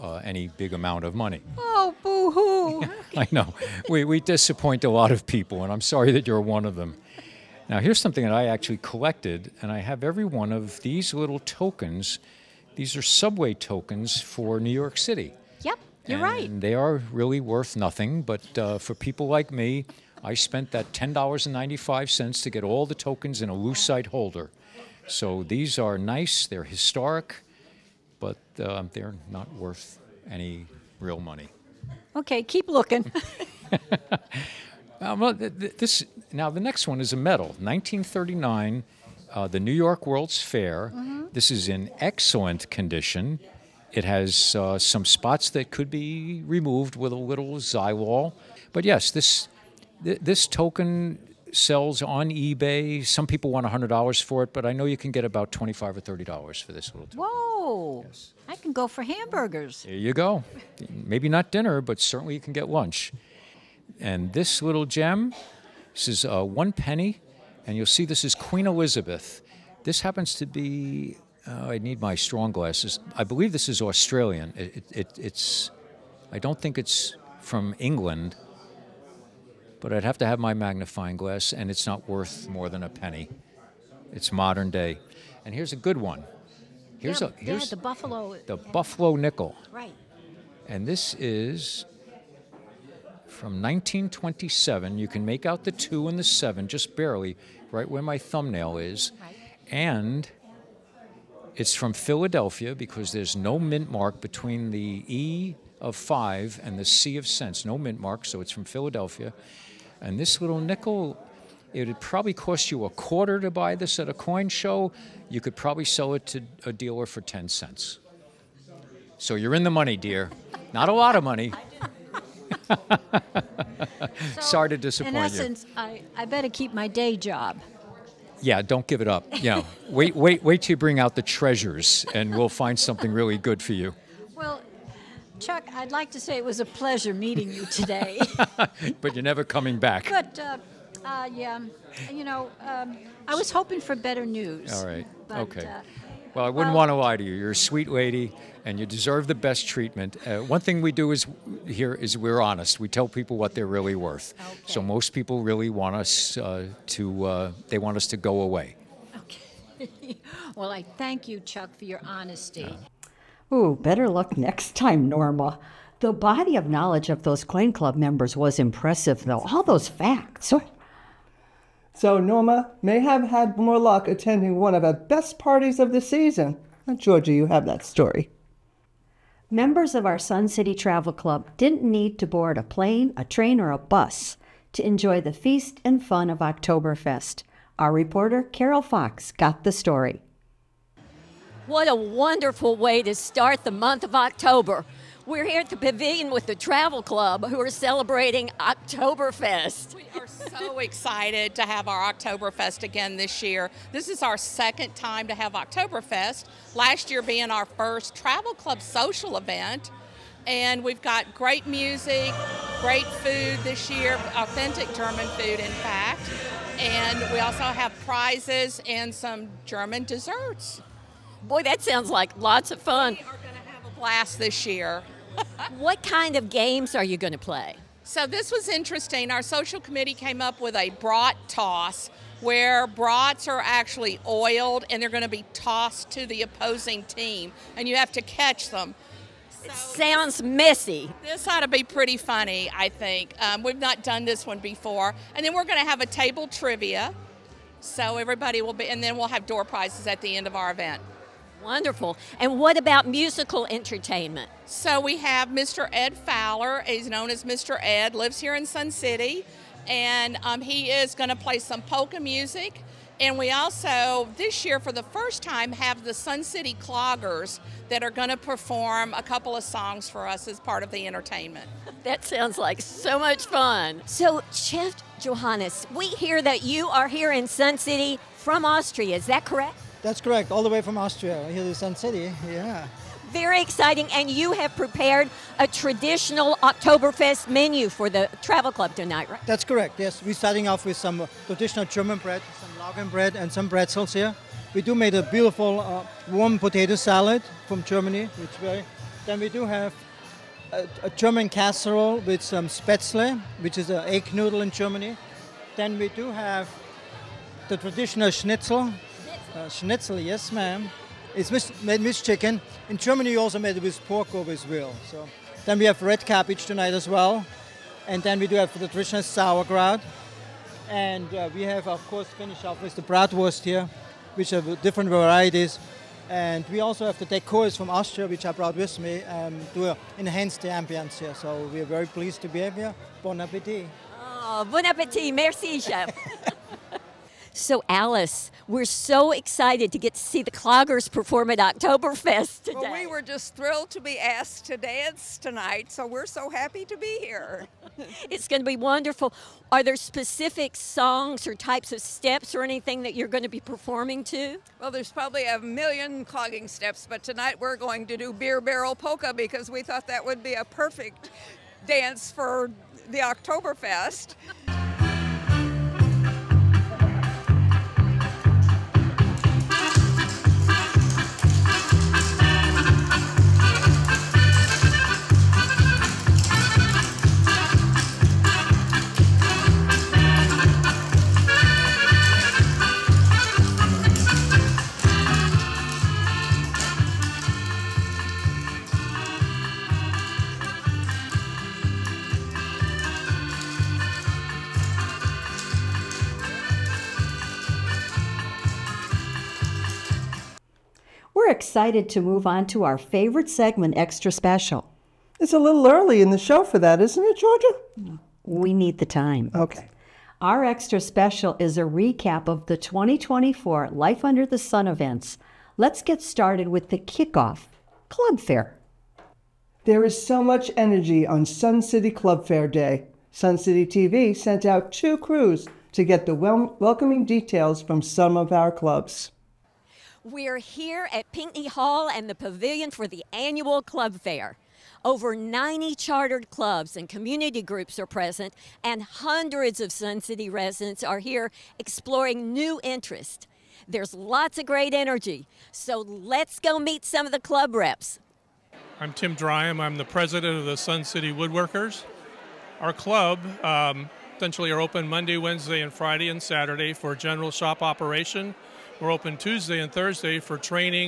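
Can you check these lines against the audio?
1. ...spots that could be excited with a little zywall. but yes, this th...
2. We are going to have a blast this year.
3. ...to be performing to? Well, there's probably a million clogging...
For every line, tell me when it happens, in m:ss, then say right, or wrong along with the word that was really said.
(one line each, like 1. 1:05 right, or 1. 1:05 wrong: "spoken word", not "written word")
1. 0:45 wrong: "removed", not "excited"
2. 3:43 right
3. 5:53 right.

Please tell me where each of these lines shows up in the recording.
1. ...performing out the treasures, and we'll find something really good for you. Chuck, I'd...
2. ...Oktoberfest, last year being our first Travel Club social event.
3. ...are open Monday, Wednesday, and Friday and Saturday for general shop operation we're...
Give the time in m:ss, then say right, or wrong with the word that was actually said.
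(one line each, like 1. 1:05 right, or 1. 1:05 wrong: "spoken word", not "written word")
1. 2:10 wrong: "bring", not "performing"
2. 3:25 right
3. 7:34 right.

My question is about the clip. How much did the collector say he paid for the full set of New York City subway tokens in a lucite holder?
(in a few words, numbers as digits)
$10.95.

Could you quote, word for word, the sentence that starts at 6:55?
Let's get started with the kickoff Club Fair.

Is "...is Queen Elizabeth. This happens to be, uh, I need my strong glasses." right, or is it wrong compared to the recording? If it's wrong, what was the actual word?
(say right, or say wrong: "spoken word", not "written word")
right.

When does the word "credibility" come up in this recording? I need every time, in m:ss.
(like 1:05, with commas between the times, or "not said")
not said.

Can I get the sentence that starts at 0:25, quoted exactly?
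So these are nice, they're historic, but uh, they're not worth any real money.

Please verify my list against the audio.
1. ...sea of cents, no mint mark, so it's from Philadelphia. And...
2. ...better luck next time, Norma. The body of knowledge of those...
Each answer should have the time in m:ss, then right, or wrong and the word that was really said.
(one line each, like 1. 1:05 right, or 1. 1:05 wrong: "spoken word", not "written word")
1. 1:46 right
2. 2:43 right.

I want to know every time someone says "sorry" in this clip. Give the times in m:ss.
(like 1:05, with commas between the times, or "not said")
0:05, 2:04.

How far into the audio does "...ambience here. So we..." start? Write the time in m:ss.
5:30.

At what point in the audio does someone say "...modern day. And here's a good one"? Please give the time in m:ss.
1:24.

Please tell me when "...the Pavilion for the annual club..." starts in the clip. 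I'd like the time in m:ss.
7:12.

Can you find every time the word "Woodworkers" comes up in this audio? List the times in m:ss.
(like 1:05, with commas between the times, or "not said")
7:31.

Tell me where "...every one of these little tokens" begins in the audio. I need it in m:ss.
0:10.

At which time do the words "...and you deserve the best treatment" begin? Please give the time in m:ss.
2:28.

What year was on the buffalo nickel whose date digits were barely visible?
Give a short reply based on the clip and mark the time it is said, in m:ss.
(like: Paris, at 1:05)
1927, at 1:33.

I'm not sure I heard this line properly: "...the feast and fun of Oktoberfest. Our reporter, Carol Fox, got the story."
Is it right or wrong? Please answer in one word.
right.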